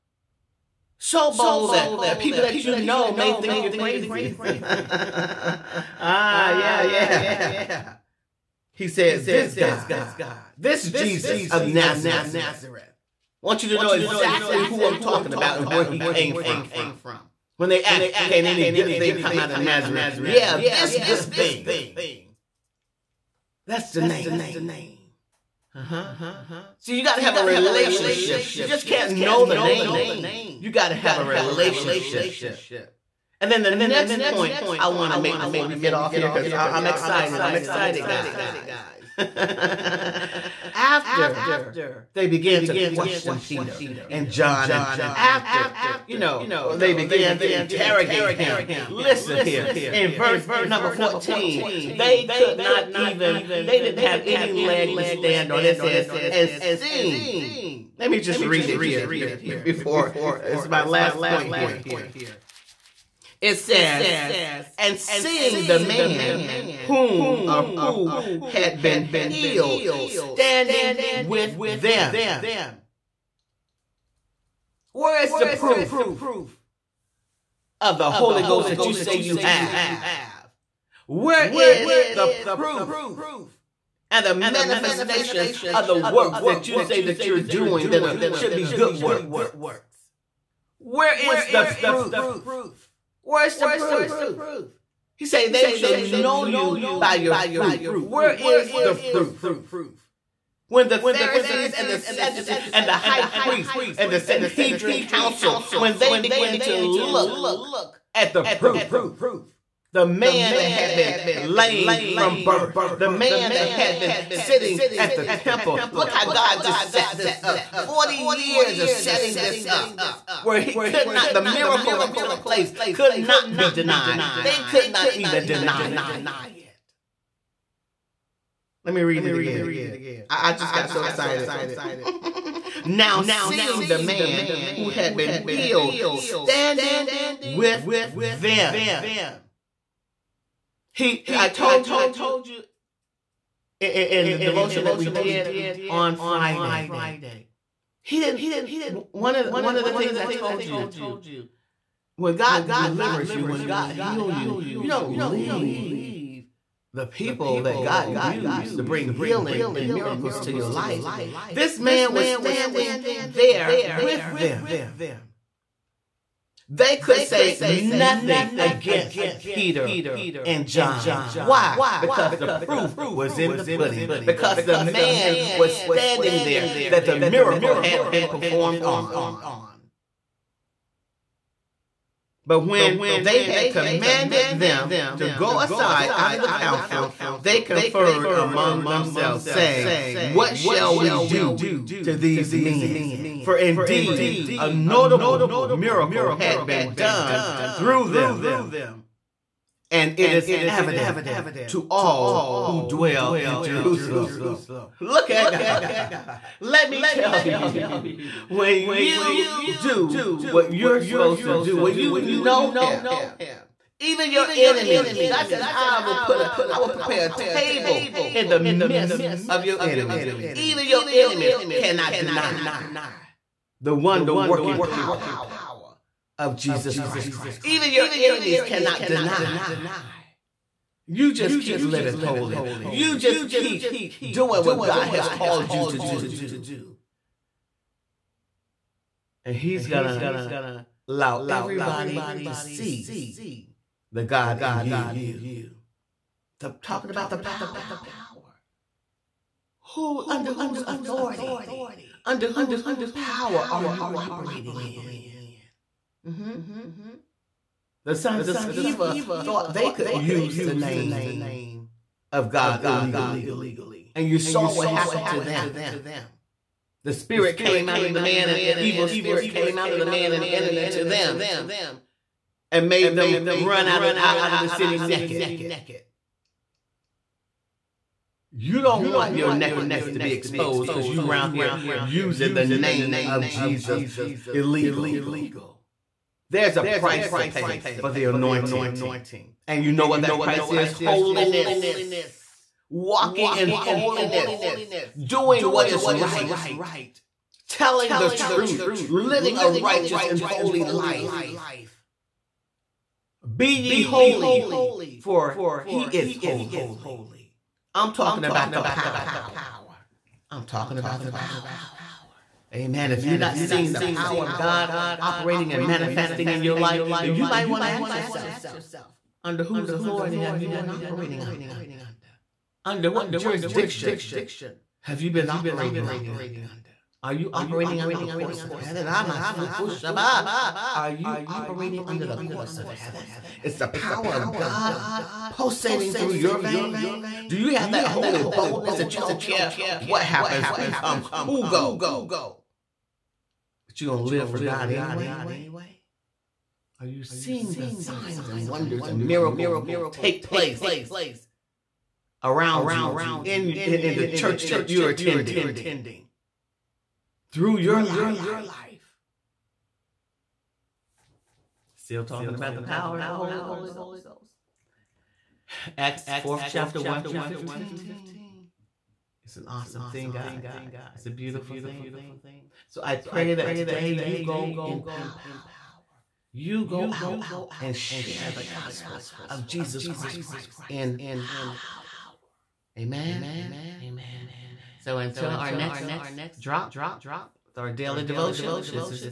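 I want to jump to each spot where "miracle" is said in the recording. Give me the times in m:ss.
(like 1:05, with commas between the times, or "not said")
2:01, 2:39, 2:57, 3:15, 5:49.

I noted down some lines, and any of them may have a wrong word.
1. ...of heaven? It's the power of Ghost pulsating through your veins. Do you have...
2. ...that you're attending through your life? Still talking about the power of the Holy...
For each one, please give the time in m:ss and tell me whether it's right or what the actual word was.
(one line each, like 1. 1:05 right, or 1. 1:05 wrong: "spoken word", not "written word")
1. 5:32 wrong: "God", not "Ghost"
2. 5:54 right.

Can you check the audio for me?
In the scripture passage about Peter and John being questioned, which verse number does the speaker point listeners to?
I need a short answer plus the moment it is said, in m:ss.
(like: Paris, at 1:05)
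14, at 0:50.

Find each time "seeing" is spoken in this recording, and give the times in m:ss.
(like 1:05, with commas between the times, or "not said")
0:56, 1:04, 2:13, 5:13, 5:47.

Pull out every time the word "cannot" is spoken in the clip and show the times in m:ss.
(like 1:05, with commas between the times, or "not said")
3:41, 3:48.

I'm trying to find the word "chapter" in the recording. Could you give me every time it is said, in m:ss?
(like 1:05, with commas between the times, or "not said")
6:06.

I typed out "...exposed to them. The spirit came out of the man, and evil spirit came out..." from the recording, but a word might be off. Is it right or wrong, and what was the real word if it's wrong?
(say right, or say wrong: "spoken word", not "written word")
wrong: "happened", not "exposed".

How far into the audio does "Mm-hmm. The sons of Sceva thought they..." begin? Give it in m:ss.
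4:16.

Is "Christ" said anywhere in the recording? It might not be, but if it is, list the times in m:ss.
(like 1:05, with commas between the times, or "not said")
3:46, 6:20.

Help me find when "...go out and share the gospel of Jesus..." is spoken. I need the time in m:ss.
6:16.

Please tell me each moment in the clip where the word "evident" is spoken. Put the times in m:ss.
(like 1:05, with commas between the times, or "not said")
3:20.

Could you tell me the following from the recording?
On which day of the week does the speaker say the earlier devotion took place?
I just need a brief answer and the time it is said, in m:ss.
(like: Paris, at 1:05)
Friday, at 2:26.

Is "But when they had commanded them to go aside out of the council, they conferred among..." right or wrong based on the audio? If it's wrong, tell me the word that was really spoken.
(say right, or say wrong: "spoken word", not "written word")
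right.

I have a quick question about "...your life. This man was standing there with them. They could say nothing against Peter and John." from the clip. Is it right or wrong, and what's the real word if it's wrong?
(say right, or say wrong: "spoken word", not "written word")
right.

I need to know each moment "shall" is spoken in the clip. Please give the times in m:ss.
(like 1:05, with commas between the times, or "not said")
1:35, 3:10.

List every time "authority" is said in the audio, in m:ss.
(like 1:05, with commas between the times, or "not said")
4:10, 5:19.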